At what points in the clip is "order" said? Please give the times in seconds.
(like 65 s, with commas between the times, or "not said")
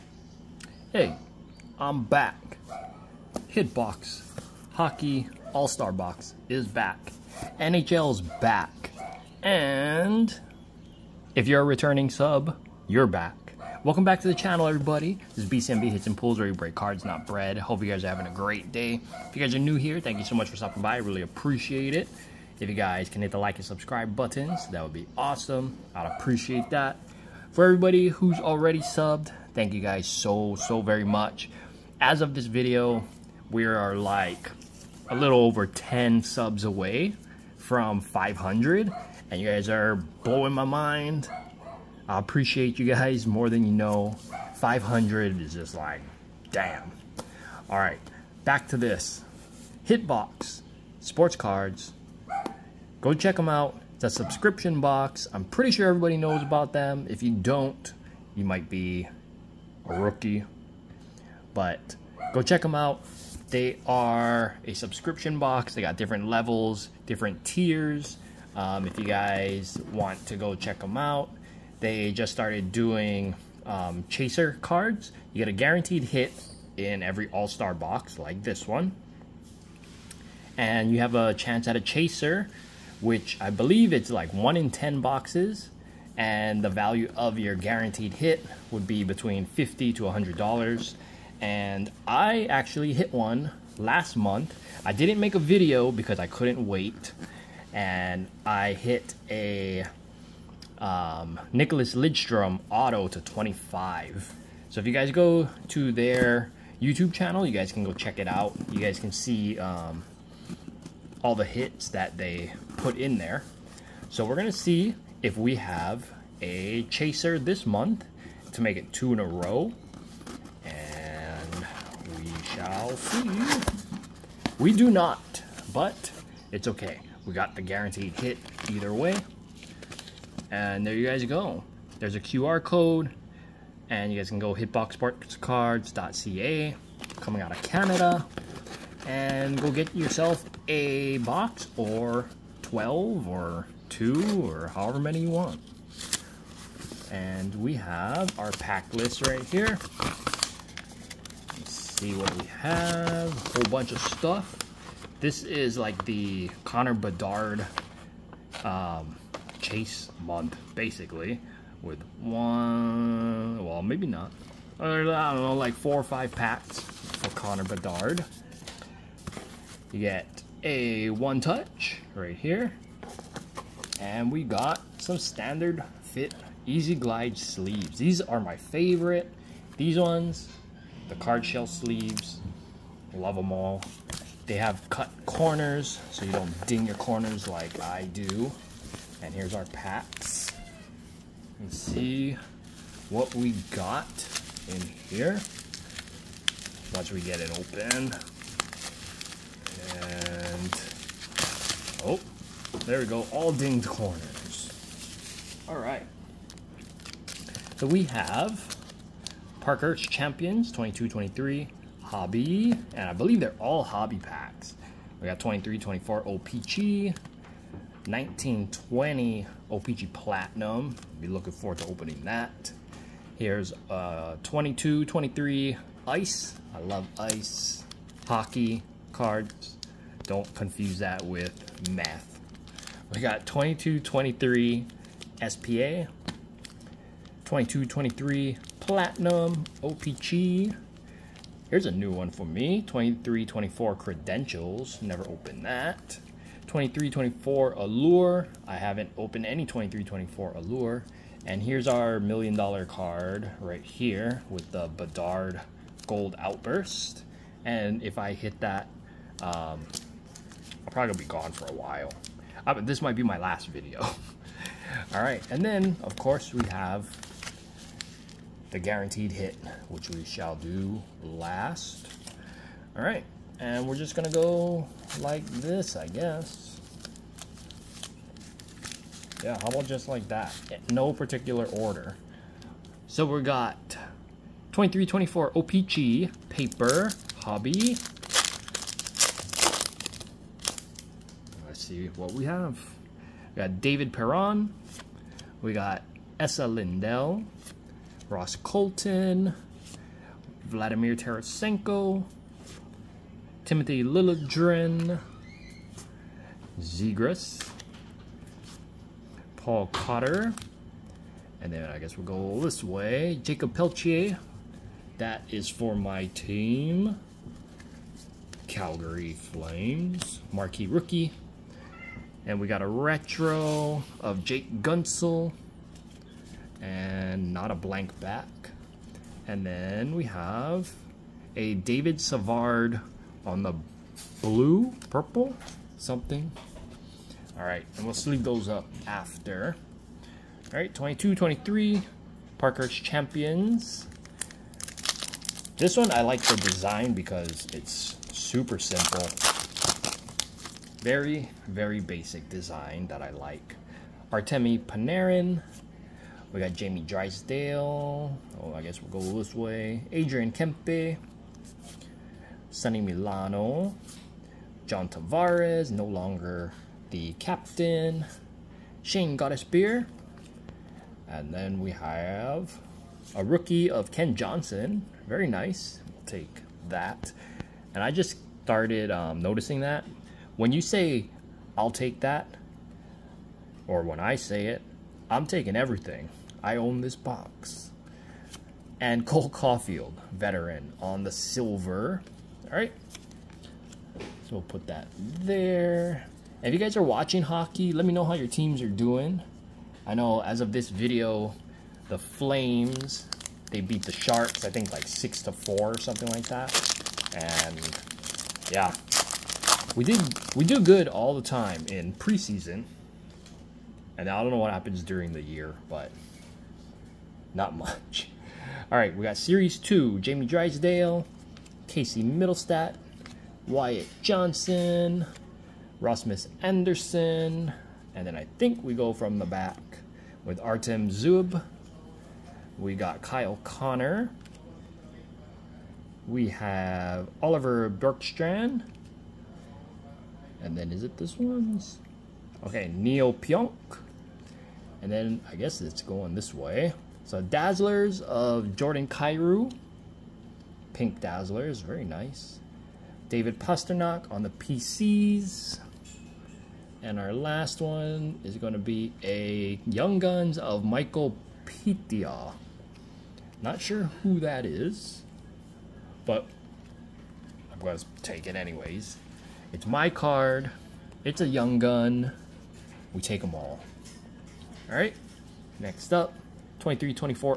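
281 s.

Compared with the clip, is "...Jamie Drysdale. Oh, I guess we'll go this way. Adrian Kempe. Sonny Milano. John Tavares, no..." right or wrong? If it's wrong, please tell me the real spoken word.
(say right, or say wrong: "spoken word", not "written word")
right.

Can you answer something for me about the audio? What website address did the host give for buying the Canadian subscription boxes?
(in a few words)
hitboxsportscards.ca.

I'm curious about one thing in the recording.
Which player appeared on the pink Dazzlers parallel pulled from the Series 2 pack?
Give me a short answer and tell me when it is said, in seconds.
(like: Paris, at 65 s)
Jordan Kyrou, at 448 s.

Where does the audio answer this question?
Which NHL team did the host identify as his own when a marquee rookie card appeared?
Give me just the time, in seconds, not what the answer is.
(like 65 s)
318 s.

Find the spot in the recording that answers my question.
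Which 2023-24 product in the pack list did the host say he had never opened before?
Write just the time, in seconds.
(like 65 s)
243 s.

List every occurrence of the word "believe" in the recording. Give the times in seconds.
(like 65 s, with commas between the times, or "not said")
83 s, 213 s.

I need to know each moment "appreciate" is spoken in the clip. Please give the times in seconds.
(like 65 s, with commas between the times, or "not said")
21 s, 26 s, 42 s.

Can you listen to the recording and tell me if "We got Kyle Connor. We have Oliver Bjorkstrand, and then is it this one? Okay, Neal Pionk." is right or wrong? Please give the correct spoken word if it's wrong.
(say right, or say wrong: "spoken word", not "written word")
right.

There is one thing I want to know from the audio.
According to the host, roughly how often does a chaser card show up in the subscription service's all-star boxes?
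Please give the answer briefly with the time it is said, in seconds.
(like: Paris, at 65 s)
1 in 10 boxes, at 84 s.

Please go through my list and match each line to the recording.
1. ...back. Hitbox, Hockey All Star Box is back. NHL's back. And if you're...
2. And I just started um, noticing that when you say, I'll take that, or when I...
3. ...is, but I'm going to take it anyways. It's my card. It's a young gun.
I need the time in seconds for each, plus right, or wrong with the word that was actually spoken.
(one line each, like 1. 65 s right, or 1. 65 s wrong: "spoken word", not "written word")
1. 2 s right
2. 377 s right
3. 464 s right.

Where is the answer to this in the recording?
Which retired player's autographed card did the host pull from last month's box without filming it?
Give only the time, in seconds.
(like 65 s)
101 s.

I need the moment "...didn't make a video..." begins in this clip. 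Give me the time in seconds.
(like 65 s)
94 s.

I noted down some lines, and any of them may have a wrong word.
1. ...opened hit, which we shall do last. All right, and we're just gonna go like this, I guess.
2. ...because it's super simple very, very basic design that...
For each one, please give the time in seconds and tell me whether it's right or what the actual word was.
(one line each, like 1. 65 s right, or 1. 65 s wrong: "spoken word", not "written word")
1. 268 s wrong: "guaranteed", not "opened"
2. 347 s right.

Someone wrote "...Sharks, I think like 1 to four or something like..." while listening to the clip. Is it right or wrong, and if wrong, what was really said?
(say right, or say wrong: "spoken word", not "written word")
wrong: "6", not "1".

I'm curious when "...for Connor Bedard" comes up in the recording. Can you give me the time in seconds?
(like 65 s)
166 s.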